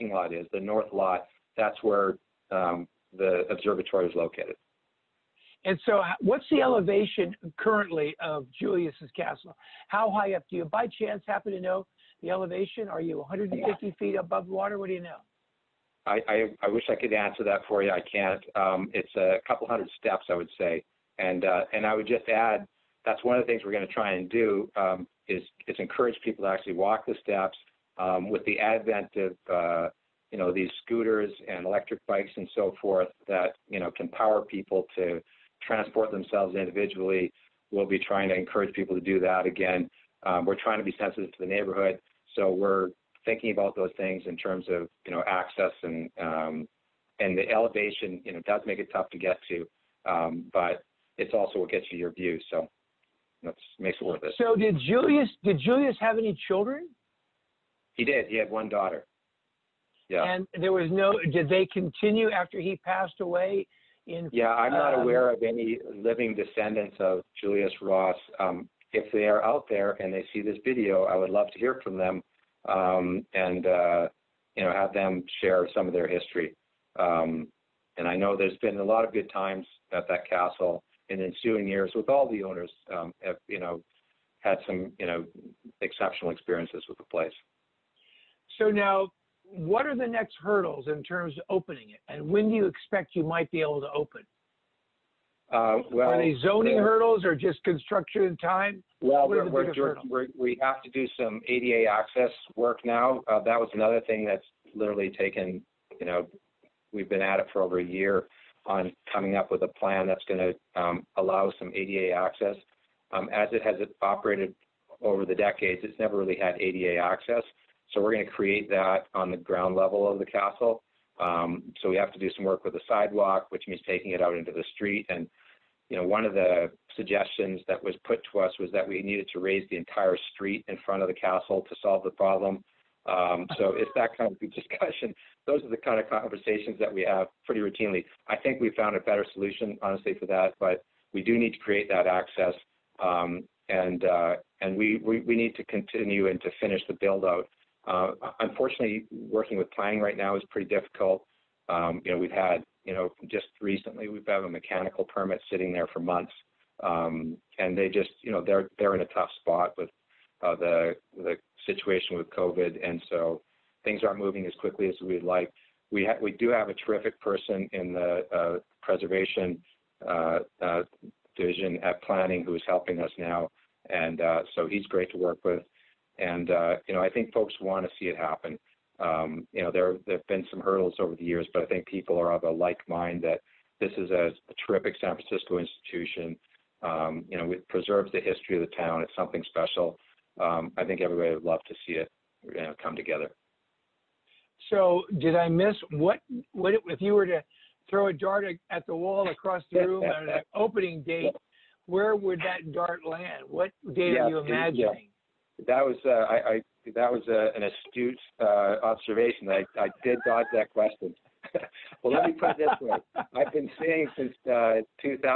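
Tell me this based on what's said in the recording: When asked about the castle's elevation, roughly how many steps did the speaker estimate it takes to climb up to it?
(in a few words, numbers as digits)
a couple hundred.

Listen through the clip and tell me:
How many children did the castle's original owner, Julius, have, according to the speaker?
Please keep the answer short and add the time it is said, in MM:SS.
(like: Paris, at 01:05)
1 daughter, at 00:58.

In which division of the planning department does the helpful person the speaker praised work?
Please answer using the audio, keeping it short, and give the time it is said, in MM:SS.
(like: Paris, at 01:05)
preservation, at 02:48.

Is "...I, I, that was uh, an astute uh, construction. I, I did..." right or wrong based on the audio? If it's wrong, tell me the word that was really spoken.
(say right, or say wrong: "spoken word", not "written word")
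wrong: "observation", not "construction".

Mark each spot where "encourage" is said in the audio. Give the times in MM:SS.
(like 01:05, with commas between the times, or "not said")
00:25, 00:38.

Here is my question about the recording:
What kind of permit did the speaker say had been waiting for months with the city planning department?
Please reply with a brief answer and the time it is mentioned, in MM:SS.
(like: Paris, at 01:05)
mechanical permit, at 02:34.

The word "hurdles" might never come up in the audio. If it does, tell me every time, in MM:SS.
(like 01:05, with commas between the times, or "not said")
01:30, 01:36, 03:00.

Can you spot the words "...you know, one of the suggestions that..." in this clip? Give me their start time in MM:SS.
02:05.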